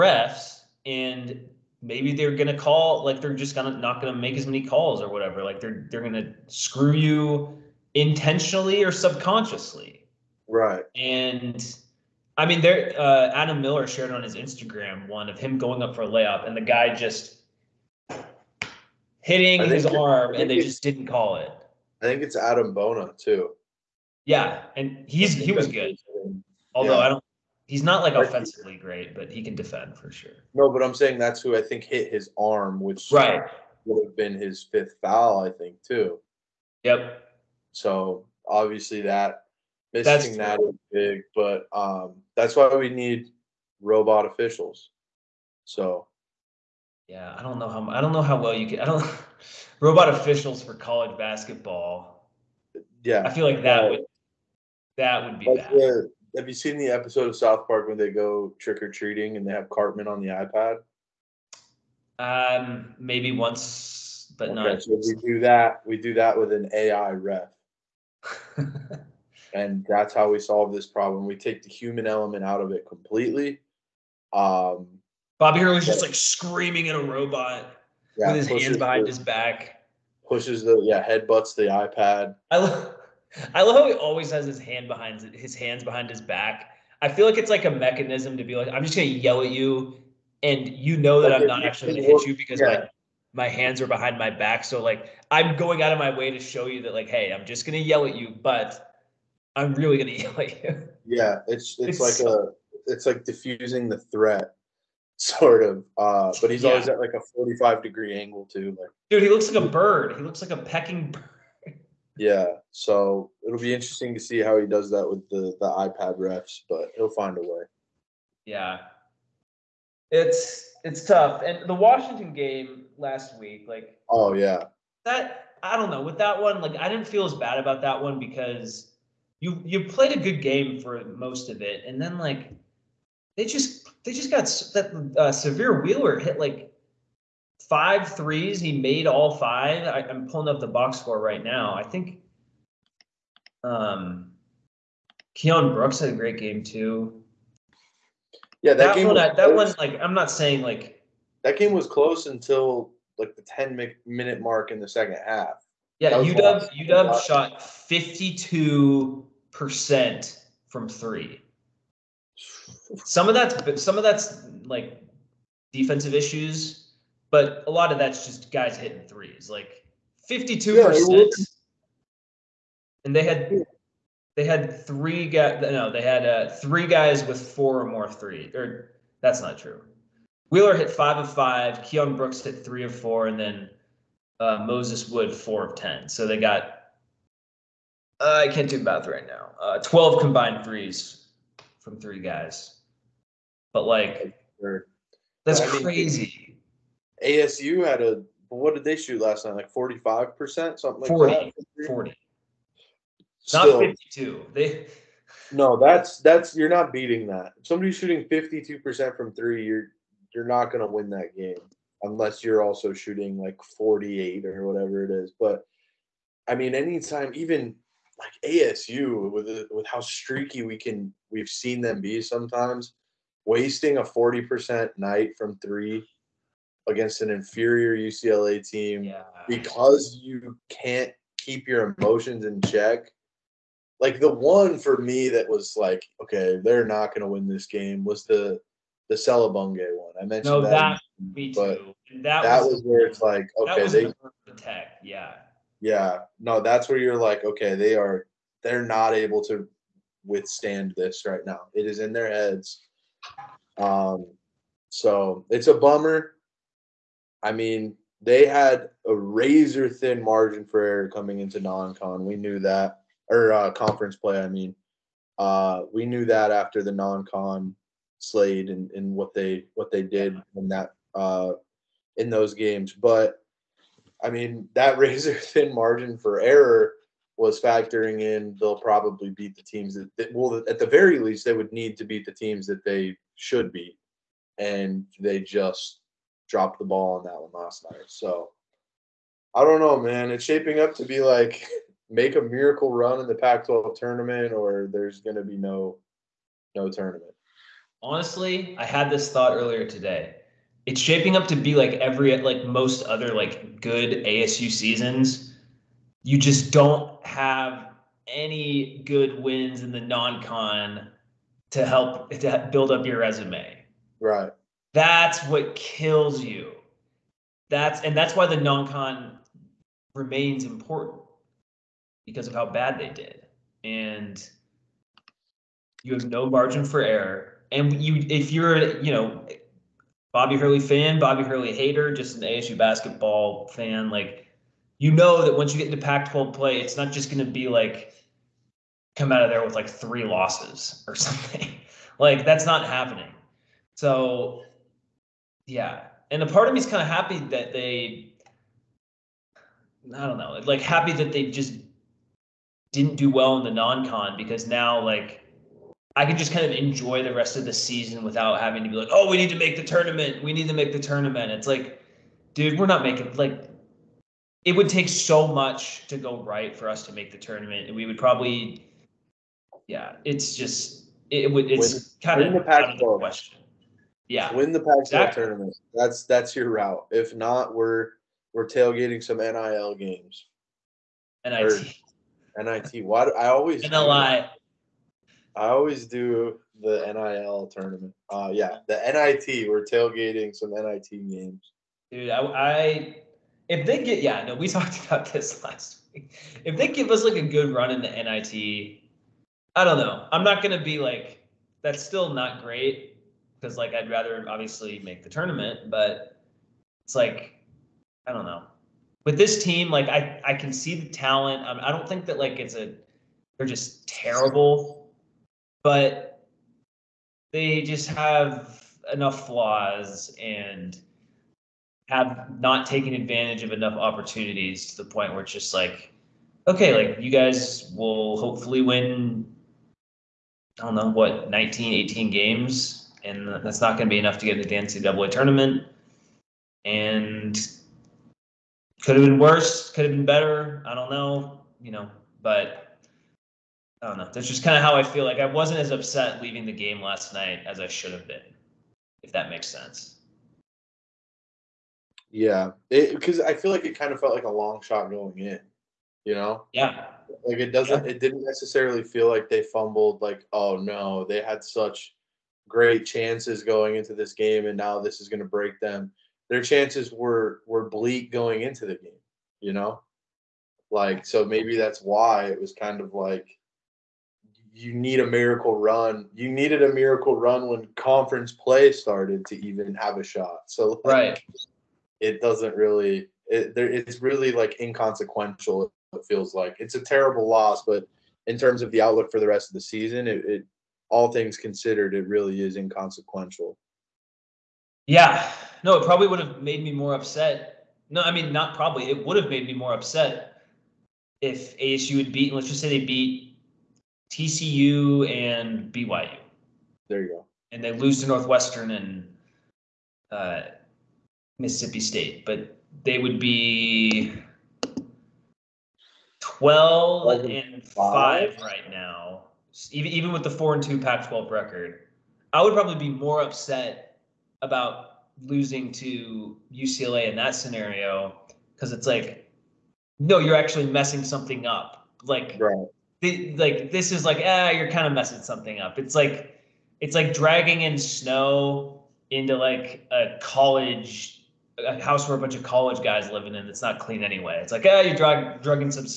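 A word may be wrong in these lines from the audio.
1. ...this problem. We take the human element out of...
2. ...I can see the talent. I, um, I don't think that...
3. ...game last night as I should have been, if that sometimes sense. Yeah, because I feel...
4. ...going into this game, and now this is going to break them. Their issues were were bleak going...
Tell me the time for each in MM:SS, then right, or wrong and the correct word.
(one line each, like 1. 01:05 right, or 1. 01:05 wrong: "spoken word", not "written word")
1. 01:10 right
2. 06:50 right
3. 07:26 wrong: "makes", not "sometimes"
4. 07:43 wrong: "chances", not "issues".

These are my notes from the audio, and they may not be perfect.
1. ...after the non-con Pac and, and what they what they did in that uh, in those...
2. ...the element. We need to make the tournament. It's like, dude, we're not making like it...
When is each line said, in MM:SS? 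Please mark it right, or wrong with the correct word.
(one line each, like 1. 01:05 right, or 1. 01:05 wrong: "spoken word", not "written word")
1. 04:26 wrong: "Slade", not "Pac"
2. 05:59 wrong: "tournament", not "element".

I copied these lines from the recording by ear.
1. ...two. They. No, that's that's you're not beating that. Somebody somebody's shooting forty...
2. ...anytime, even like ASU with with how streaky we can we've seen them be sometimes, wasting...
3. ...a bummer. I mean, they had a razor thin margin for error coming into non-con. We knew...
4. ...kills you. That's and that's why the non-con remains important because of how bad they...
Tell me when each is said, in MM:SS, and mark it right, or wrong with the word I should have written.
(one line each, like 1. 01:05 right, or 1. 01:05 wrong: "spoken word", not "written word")
1. 03:24 wrong: "fifty", not "forty"
2. 03:36 right
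3. 04:15 right
4. 05:15 right.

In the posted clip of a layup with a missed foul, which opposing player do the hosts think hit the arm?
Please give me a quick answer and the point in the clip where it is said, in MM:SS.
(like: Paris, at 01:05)
Adem Bona, at 00:22.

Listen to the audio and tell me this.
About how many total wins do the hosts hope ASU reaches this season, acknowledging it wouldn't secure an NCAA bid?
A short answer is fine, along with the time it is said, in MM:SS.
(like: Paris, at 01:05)
19, at 07:11.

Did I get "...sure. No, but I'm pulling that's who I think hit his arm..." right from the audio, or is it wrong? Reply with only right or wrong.
wrong.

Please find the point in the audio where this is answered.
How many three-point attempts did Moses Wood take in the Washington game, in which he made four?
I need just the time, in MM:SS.
03:05.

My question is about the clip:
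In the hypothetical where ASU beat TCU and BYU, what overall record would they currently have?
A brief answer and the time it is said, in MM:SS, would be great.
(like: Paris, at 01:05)
12-5, at 08:36.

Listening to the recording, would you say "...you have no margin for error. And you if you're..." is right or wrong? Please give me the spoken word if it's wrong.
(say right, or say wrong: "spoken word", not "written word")
right.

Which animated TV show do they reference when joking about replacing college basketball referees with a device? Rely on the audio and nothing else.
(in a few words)
South Park.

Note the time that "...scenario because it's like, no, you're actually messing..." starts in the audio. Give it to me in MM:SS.
08:47.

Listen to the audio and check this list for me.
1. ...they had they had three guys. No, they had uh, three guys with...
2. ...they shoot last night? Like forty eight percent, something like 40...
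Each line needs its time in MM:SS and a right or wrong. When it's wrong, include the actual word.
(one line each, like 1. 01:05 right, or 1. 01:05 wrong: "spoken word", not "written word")
1. 02:53 right
2. 03:18 wrong: "five", not "eight".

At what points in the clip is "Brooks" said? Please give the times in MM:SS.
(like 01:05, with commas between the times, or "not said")
02:25, 03:02.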